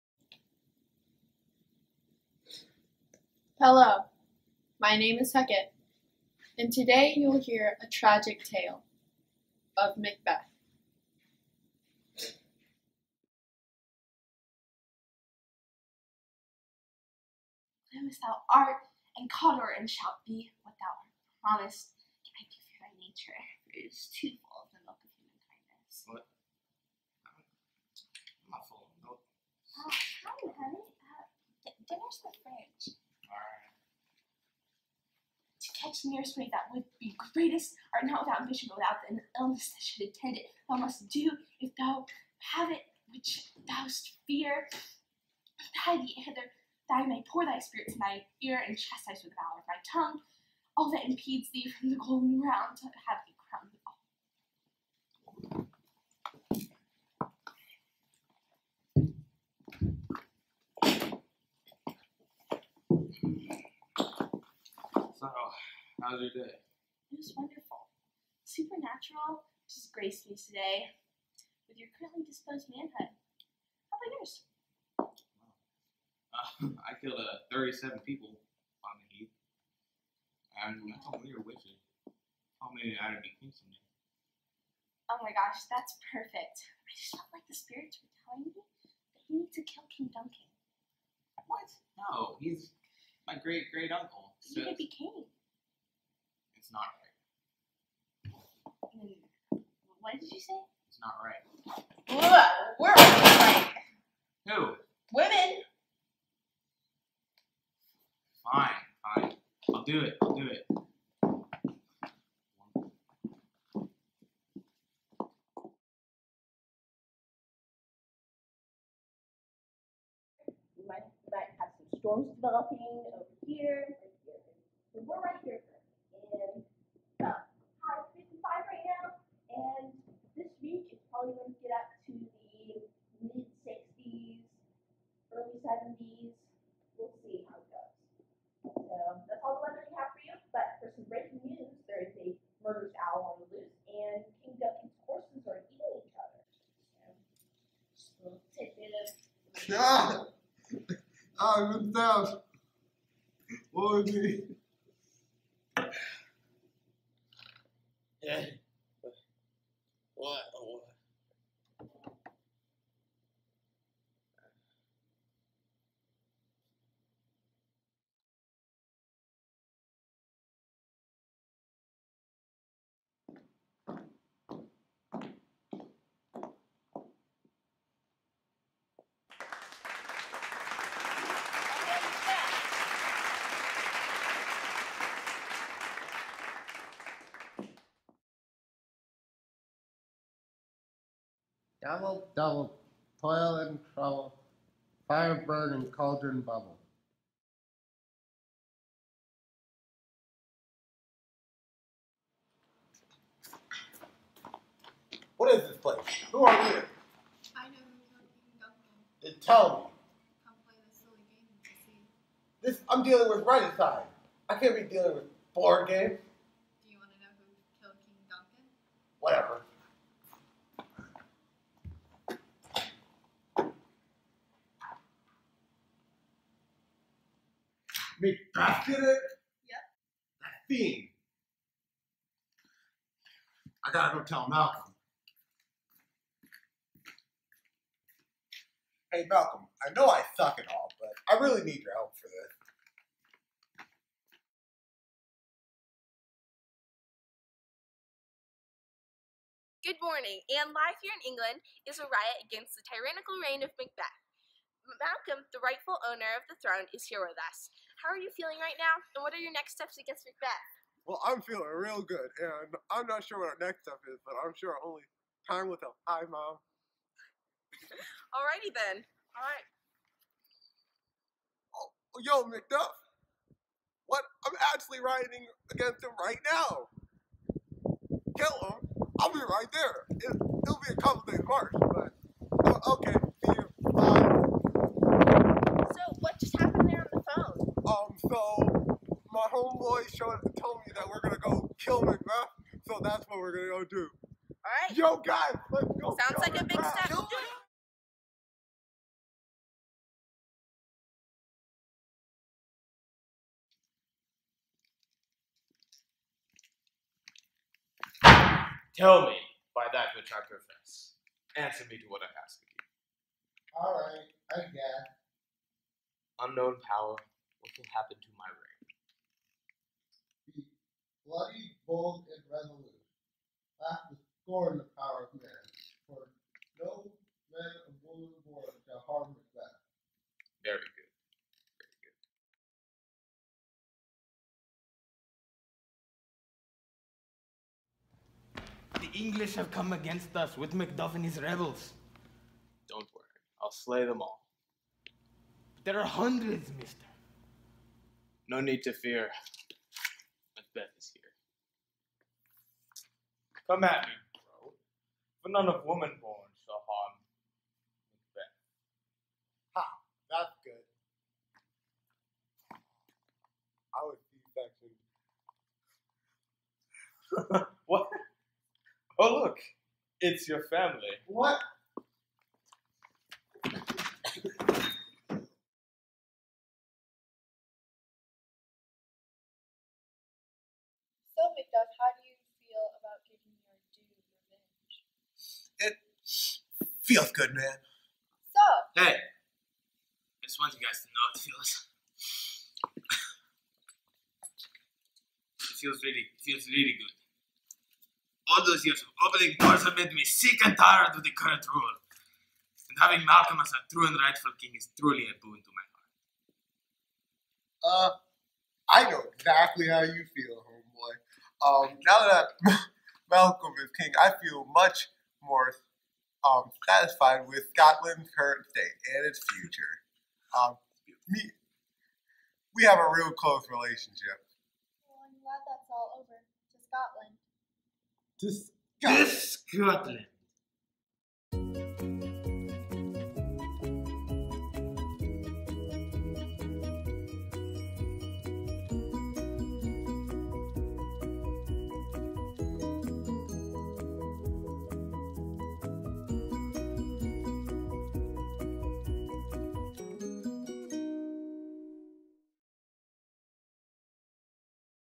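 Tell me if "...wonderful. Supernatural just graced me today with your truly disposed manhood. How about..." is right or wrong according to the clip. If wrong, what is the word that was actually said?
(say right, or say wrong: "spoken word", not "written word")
wrong: "currently", not "truly".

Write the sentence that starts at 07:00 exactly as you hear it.
Um, me, we have a real close relationship.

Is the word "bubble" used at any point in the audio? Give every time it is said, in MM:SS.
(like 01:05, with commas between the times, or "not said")
03:16.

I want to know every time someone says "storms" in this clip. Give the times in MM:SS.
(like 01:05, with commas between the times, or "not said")
02:01.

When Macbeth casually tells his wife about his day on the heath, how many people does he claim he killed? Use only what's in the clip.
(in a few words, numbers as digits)
37.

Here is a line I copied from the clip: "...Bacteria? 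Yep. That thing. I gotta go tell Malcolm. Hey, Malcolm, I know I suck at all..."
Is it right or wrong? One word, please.
right.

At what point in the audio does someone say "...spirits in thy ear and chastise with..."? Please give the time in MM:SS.
00:47.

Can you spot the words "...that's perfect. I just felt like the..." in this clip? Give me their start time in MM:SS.
01:25.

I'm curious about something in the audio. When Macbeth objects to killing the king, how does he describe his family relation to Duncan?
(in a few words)
great great uncle.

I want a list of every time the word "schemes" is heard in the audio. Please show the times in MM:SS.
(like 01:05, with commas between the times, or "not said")
not said.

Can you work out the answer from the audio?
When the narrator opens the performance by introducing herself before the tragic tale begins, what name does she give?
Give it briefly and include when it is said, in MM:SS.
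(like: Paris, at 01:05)
Hecate, at 00:05.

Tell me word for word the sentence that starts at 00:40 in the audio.
Thou must do if thou have it which thou'st fear.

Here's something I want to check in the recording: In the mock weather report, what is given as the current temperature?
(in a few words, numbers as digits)
high 55.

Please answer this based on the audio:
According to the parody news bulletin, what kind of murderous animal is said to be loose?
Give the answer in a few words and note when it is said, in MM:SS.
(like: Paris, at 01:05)
owl, at 02:22.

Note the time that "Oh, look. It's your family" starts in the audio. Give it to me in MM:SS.
06:09.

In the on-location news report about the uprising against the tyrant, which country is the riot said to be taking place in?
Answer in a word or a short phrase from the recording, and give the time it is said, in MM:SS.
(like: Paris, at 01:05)
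England, at 04:11.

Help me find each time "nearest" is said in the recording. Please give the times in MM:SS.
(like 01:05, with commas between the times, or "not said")
00:36.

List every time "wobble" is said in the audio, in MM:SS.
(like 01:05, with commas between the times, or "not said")
not said.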